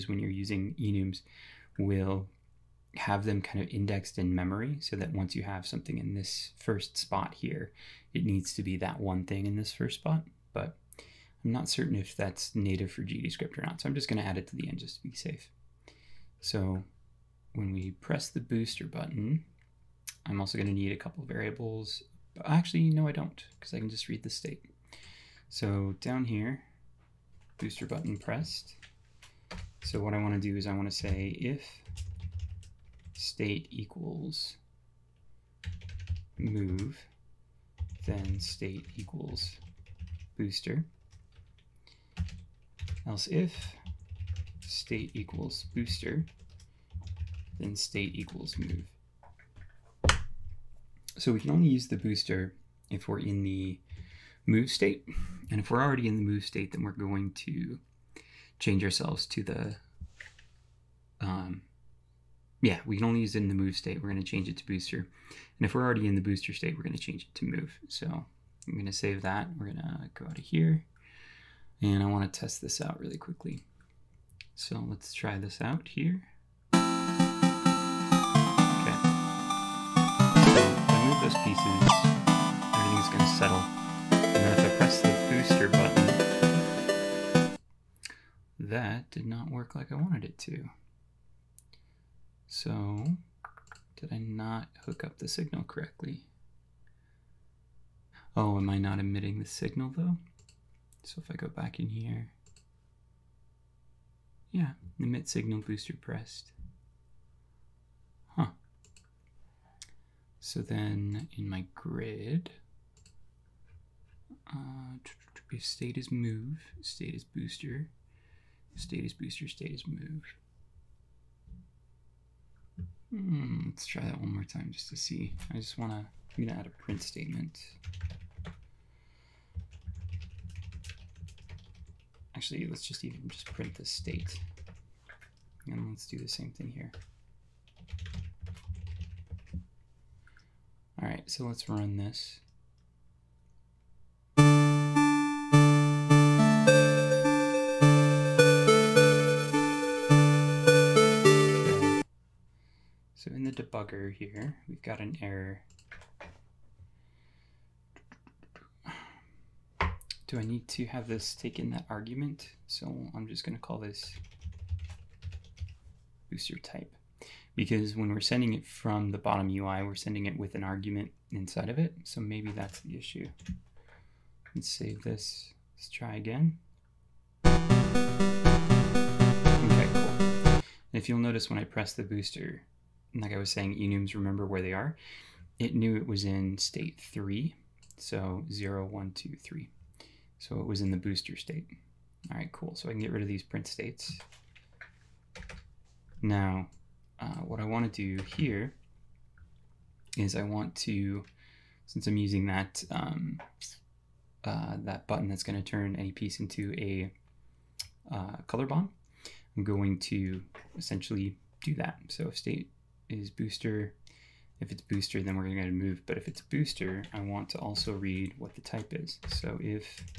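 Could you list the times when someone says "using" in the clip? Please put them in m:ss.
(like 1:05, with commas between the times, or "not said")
0:00, 3:22.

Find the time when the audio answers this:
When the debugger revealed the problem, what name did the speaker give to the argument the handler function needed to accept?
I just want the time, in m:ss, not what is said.
2:46.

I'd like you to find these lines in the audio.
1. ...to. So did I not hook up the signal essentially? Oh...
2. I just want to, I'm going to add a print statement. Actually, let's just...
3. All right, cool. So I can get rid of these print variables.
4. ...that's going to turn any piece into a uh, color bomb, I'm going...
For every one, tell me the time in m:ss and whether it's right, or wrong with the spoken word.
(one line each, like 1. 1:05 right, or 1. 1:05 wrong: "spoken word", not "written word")
1. 1:30 wrong: "correctly", not "essentially"
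2. 2:05 right
3. 3:12 wrong: "states", not "variables"
4. 3:25 right.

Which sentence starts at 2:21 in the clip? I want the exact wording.
All right, so let's run this.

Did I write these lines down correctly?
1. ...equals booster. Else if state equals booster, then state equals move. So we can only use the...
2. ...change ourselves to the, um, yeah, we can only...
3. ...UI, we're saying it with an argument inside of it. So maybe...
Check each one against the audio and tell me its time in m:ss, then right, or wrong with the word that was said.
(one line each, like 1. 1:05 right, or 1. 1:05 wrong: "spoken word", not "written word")
1. 0:38 right
2. 0:58 right
3. 2:49 wrong: "sending", not "saying".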